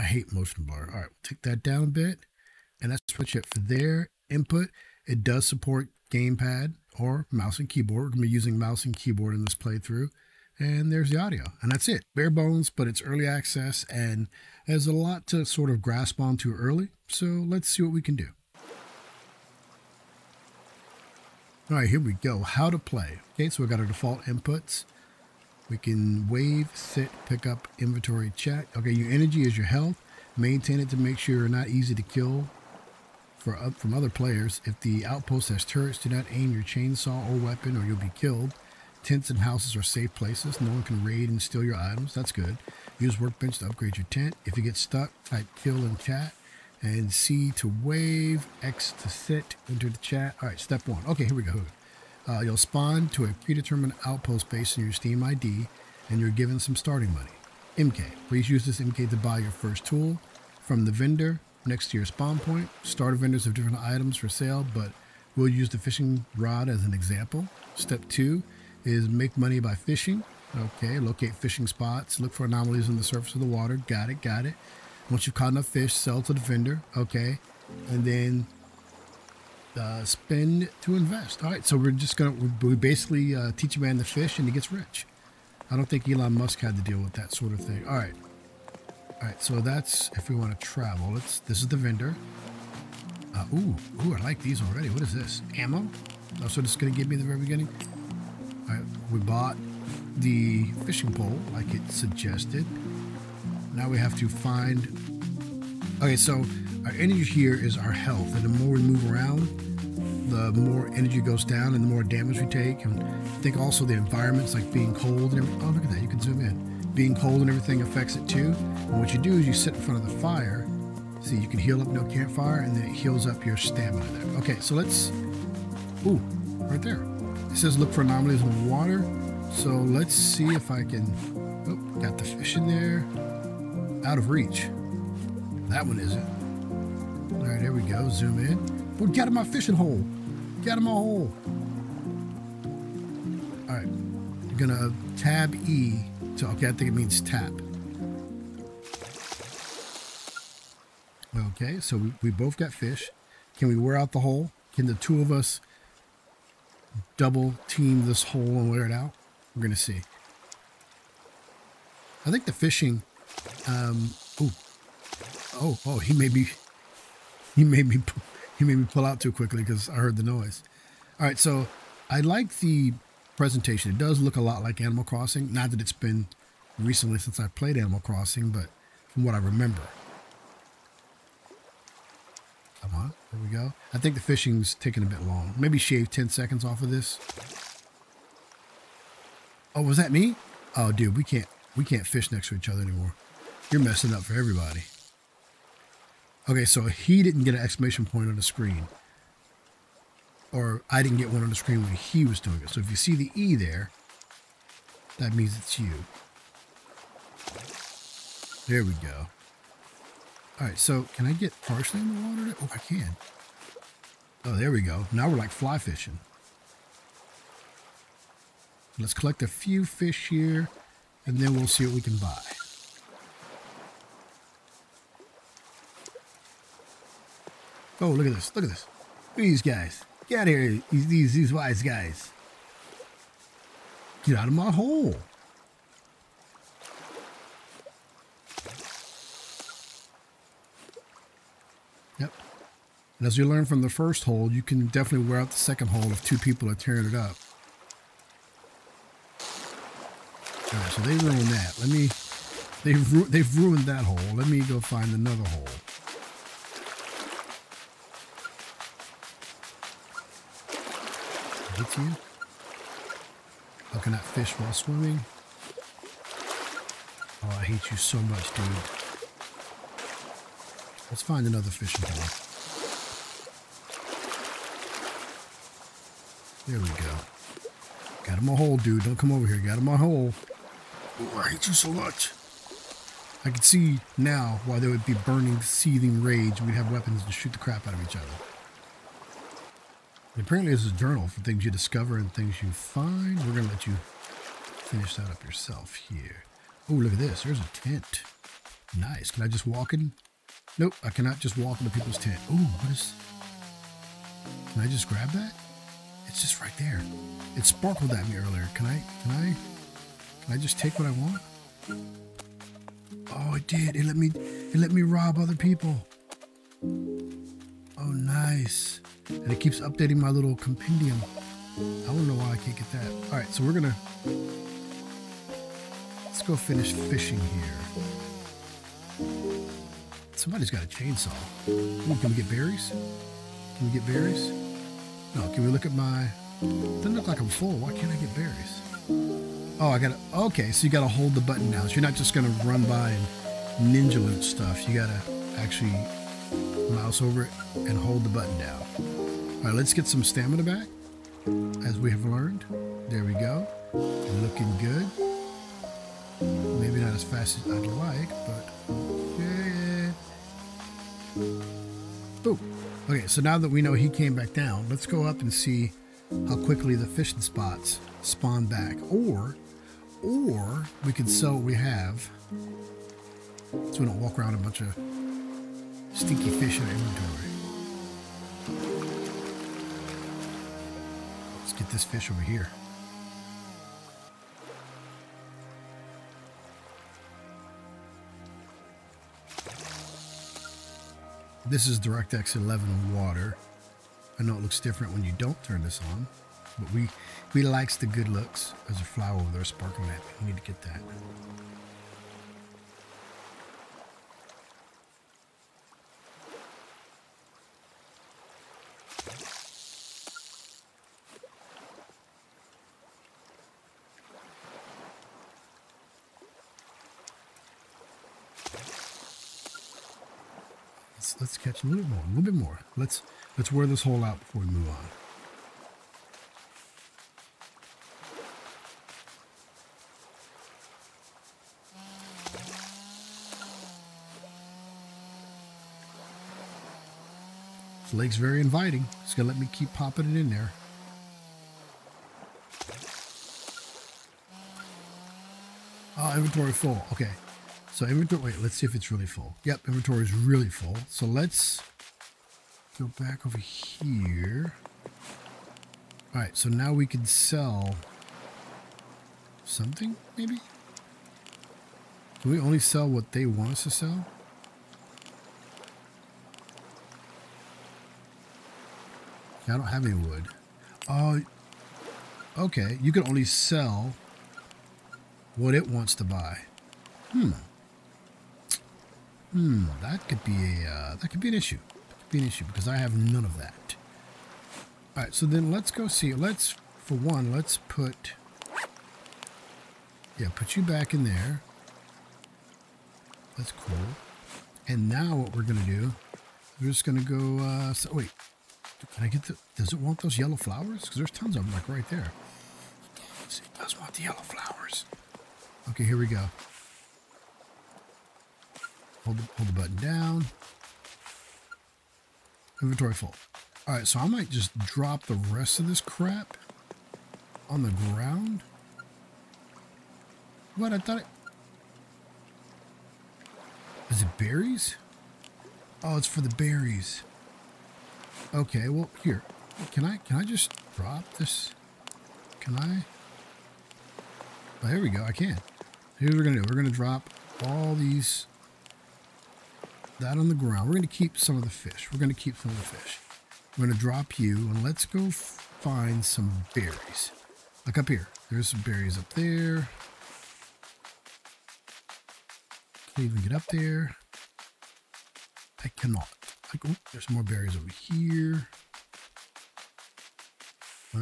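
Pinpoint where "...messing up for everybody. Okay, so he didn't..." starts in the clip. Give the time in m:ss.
3:13.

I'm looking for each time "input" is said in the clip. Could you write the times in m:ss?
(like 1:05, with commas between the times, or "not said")
0:04, 0:24.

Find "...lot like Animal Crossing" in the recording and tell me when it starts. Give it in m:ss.
2:54.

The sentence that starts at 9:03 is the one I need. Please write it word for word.
I'm going to drop you and let's go find some berries.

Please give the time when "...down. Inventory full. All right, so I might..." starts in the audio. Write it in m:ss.
8:29.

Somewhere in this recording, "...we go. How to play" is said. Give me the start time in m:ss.
0:22.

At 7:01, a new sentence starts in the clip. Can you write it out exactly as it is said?
Just a little more, a little bit more.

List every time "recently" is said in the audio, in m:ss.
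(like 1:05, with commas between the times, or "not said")
2:56.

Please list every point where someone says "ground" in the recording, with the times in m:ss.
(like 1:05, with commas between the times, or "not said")
8:37, 9:00.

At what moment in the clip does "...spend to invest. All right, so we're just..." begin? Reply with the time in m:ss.
1:20.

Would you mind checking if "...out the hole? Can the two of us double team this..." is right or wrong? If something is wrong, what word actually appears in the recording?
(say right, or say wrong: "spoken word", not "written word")
right.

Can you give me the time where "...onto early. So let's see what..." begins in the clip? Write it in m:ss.
0:16.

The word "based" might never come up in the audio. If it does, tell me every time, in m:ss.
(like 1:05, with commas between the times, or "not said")
0:54.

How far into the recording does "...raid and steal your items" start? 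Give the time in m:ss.
0:41.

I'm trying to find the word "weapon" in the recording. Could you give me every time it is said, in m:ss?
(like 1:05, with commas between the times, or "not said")
0:37, 4:46.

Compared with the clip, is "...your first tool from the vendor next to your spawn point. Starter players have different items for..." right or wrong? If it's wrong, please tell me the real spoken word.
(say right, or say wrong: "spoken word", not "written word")
wrong: "vendors", not "players".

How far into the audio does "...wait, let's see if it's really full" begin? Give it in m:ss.
7:28.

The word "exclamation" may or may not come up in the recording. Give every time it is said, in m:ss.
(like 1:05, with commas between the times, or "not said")
3:17.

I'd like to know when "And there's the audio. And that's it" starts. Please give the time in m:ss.
0:10.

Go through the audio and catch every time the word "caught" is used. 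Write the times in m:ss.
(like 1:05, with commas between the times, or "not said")
1:15.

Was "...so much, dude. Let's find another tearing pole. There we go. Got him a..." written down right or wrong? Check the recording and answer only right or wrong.
wrong.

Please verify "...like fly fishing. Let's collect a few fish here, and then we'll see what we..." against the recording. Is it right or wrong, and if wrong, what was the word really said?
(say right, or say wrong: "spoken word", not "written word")
right.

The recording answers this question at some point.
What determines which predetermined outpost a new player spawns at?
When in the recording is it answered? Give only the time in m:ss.
0:54.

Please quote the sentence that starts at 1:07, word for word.
Step two is make money by fishing.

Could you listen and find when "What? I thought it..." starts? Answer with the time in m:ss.
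8:40.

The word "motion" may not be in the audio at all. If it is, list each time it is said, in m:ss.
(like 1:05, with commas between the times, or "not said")
0:00.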